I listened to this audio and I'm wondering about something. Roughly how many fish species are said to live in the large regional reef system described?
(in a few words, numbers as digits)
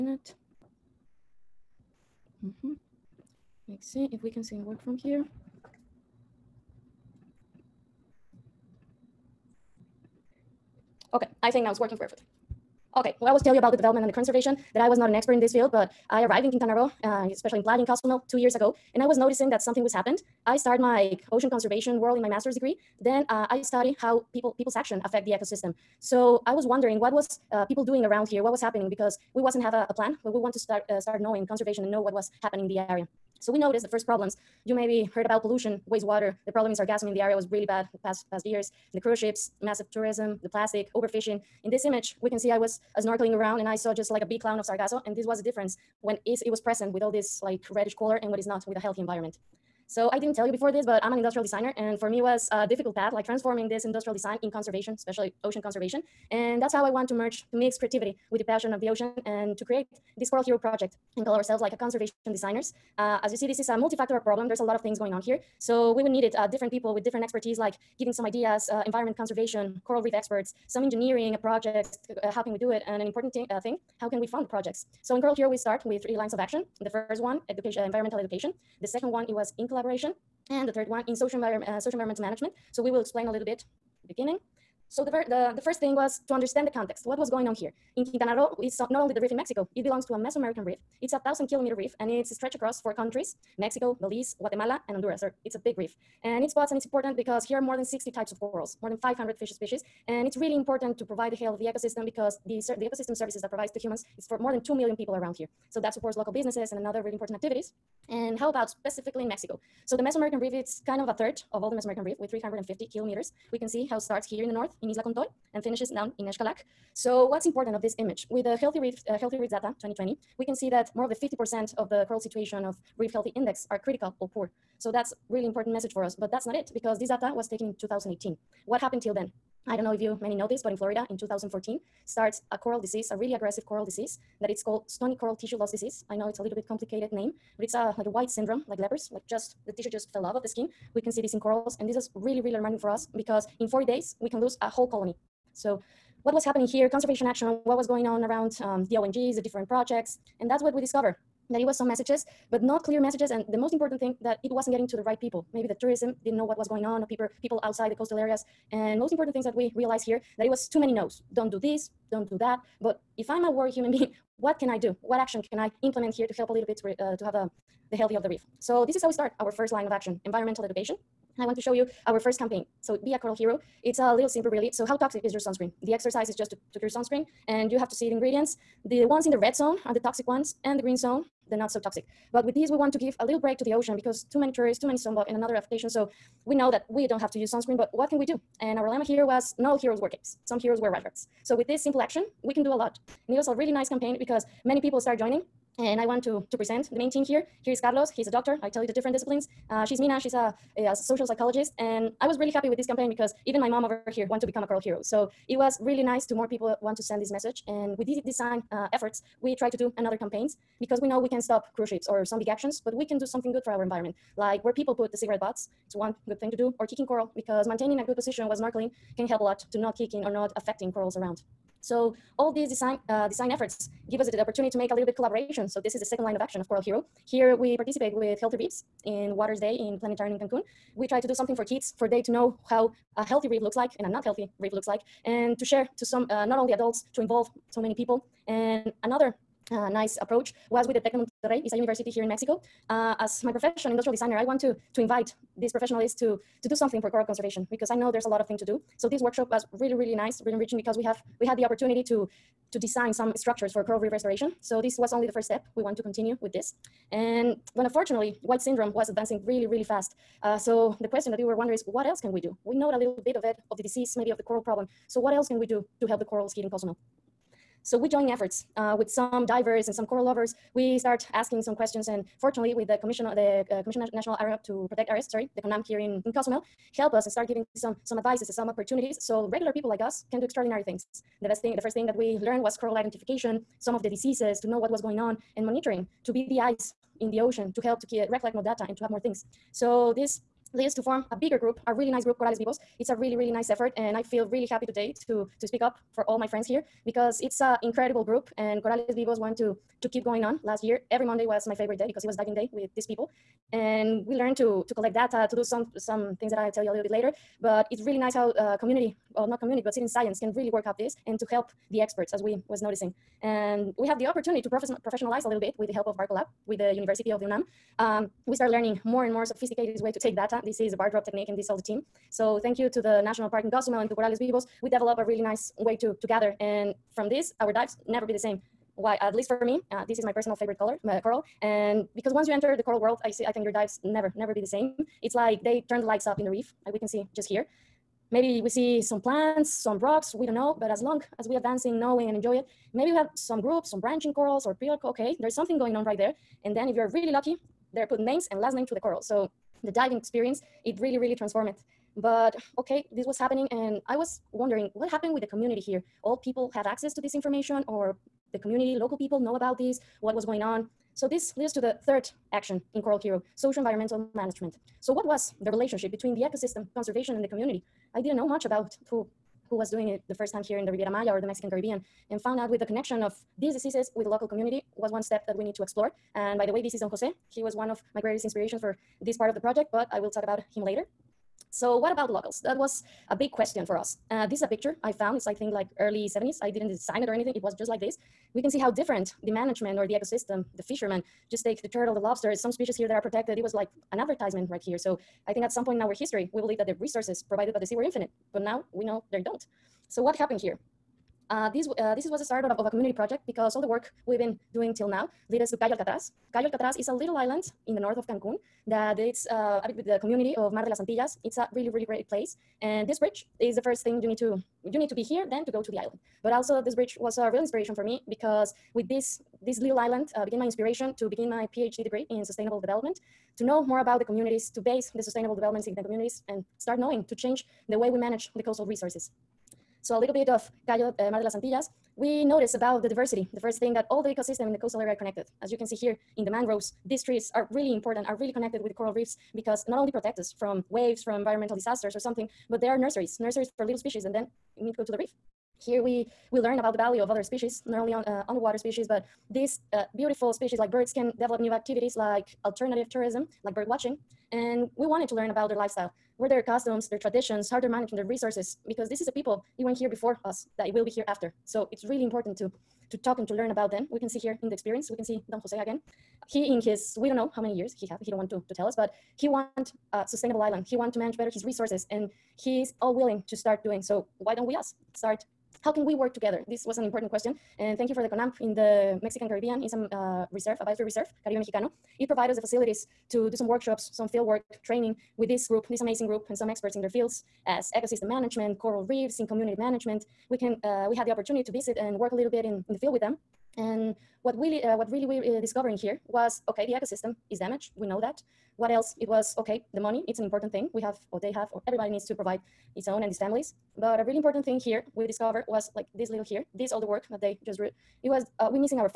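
More than 500.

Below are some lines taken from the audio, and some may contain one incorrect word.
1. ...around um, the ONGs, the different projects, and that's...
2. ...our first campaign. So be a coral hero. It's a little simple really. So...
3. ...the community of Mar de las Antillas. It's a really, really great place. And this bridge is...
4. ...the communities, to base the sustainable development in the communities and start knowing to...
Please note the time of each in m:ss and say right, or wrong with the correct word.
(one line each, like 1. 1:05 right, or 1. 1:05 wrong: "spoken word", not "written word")
1. 2:28 right
2. 2:52 right
3. 6:50 right
4. 7:04 right.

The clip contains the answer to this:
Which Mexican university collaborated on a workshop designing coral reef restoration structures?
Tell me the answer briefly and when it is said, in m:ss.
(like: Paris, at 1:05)
Tecno Monterrey, at 4:00.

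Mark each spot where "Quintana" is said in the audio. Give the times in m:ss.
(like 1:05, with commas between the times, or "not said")
0:16, 1:28.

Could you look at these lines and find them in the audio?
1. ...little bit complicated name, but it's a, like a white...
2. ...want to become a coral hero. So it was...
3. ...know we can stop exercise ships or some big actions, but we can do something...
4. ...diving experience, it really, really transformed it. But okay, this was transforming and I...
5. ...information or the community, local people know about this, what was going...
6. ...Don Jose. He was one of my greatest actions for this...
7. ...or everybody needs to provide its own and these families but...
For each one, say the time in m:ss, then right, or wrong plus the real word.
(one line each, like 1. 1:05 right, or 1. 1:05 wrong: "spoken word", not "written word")
1. 2:16 right
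2. 3:24 right
3. 3:31 wrong: "cruise", not "exercise"
4. 5:49 wrong: "happening", not "transforming"
5. 5:57 right
6. 6:16 wrong: "inspirations", not "actions"
7. 8:21 right.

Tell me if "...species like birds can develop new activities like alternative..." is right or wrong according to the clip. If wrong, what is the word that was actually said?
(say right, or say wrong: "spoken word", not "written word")
right.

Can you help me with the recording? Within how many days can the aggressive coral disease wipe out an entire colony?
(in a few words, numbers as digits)
40 days.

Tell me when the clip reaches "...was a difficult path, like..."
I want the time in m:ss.
0:52.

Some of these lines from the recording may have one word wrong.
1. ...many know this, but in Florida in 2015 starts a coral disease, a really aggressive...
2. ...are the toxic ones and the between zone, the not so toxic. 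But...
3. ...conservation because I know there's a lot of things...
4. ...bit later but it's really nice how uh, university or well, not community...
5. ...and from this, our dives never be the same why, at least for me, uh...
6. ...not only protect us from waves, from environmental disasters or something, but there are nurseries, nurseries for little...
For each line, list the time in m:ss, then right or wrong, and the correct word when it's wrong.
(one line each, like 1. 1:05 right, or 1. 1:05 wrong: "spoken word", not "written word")
1. 2:10 wrong: "2014", not "2015"
2. 2:59 wrong: "green", not "between"
3. 4:07 right
4. 5:07 wrong: "community", not "university"
5. 5:26 right
6. 7:19 right.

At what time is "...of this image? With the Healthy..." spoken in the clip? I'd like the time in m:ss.
1:57.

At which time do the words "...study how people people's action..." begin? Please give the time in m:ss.
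0:23.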